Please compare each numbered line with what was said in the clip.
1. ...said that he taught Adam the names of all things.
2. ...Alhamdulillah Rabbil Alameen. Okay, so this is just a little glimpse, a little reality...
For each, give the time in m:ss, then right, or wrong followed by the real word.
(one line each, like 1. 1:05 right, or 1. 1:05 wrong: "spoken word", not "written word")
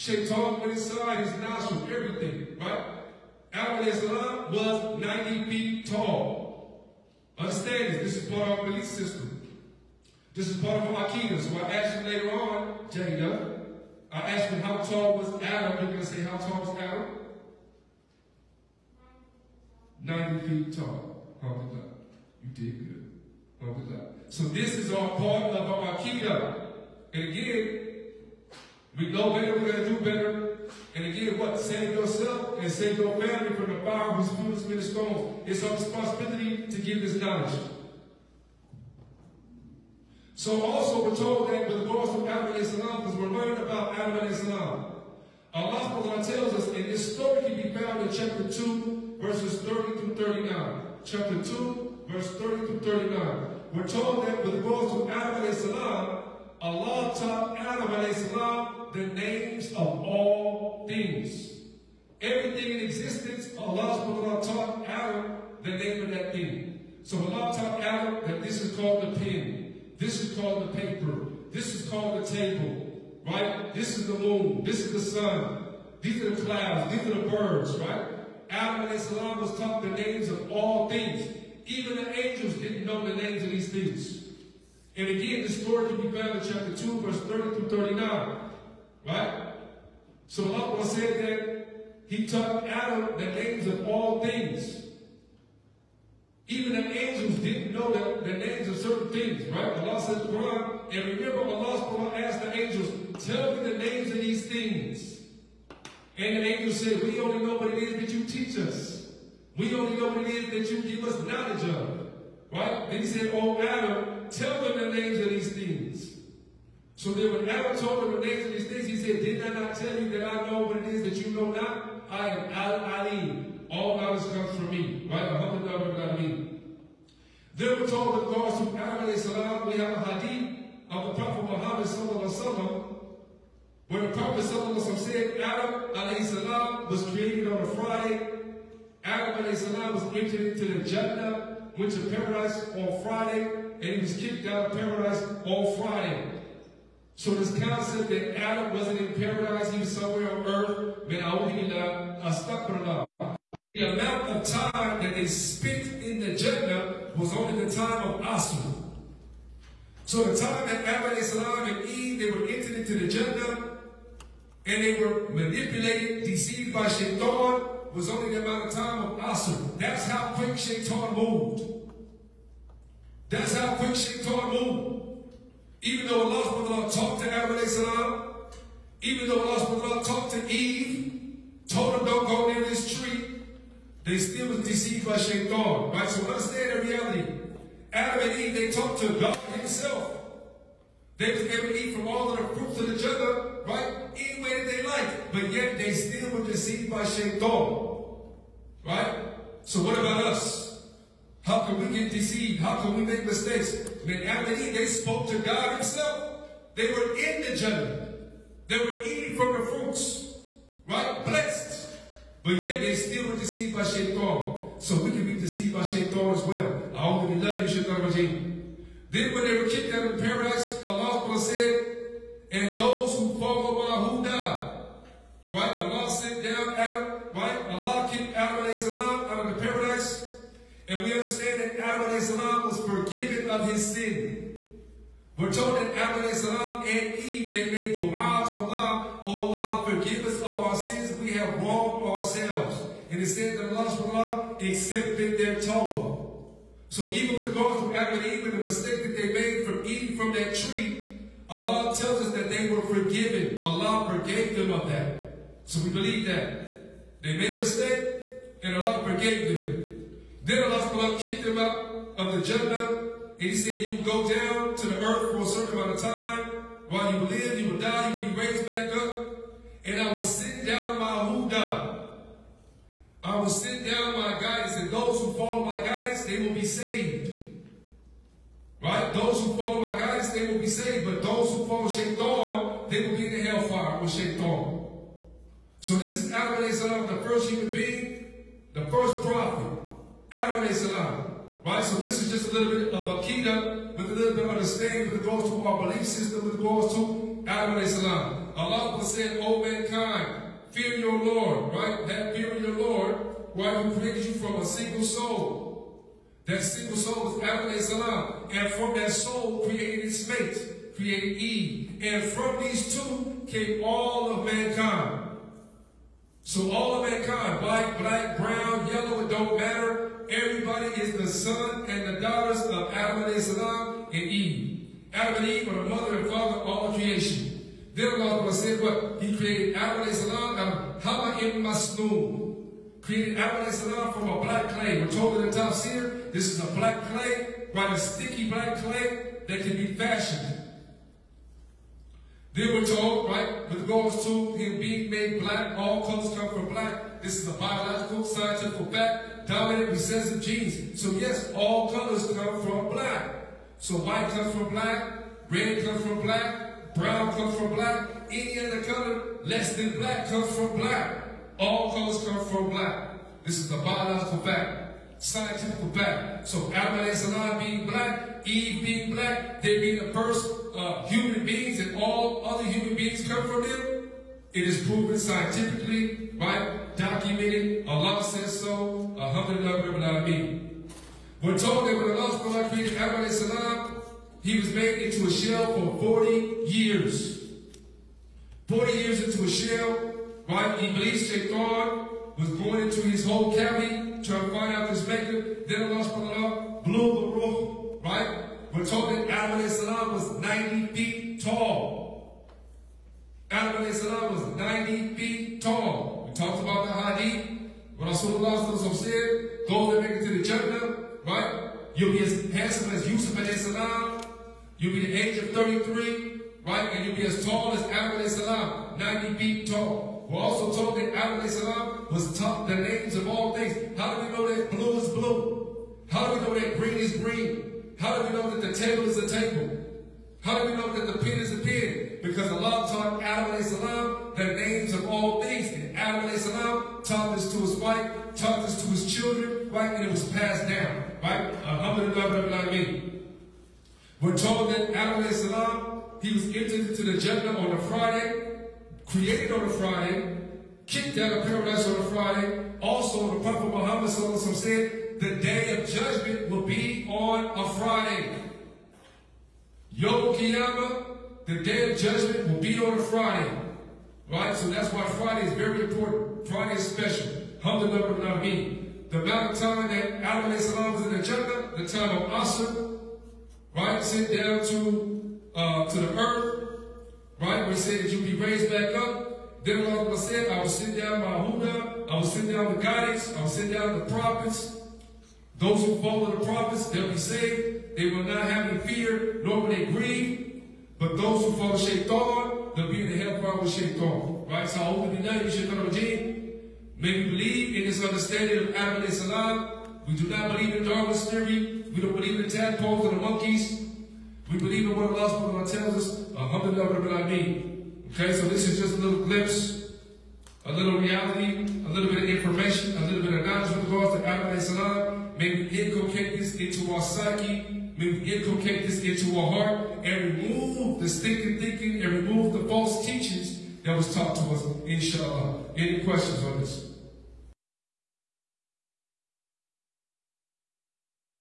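1. 1:30 right
2. 8:26 right.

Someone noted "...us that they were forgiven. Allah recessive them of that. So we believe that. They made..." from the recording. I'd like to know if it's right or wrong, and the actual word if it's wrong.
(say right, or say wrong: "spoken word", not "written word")
wrong: "forgave", not "recessive".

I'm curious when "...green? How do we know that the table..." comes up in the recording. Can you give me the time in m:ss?
7:07.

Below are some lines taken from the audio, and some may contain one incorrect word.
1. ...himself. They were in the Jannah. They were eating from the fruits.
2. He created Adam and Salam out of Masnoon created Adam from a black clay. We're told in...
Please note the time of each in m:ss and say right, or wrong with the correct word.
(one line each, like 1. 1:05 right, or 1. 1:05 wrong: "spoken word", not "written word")
1. 3:25 right
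2. 5:29 right.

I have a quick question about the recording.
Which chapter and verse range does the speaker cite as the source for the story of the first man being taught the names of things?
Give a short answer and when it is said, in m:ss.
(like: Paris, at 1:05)
2:30-39, at 0:48.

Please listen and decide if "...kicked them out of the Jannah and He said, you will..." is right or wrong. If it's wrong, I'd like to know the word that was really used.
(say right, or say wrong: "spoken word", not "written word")
right.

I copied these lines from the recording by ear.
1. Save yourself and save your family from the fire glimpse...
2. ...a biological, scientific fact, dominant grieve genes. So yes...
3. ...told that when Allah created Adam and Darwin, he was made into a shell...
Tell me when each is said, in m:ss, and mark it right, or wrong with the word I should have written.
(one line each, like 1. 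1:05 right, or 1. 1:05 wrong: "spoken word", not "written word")
1. 0:31 wrong: "whose", not "glimpse"
2. 5:47 wrong: "recessive", not "grieve"
3. 6:21 wrong: "Salam", not "Darwin".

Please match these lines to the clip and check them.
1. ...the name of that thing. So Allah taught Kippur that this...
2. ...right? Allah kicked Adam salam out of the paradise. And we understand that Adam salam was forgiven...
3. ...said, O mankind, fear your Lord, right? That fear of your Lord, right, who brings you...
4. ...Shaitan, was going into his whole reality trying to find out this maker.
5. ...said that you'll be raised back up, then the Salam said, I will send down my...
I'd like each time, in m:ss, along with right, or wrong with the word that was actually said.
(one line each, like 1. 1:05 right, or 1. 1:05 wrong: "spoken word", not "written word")
1. 1:05 wrong: "Adam", not "Kippur"
2. 3:47 right
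3. 4:59 right
4. 6:31 wrong: "cavity", not "reality"
5. 7:57 wrong: "Lord", not "Salam".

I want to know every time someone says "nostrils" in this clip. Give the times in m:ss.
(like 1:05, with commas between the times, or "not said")
0:01.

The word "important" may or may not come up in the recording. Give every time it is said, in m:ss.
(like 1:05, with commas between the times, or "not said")
7:45.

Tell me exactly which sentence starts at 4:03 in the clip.
And it said that Allah subhanahu accepted their tawbah.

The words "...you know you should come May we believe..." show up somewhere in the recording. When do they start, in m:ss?
8:15.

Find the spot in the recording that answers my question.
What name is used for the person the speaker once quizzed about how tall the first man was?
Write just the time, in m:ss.
0:12.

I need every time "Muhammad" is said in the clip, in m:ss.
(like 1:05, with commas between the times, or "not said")
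2:11, 7:33.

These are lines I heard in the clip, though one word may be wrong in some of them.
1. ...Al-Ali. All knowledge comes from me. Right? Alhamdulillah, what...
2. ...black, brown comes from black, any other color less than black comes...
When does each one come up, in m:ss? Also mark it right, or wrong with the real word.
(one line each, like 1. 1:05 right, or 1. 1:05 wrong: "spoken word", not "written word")
1. 2:02 right
2. 5:56 right.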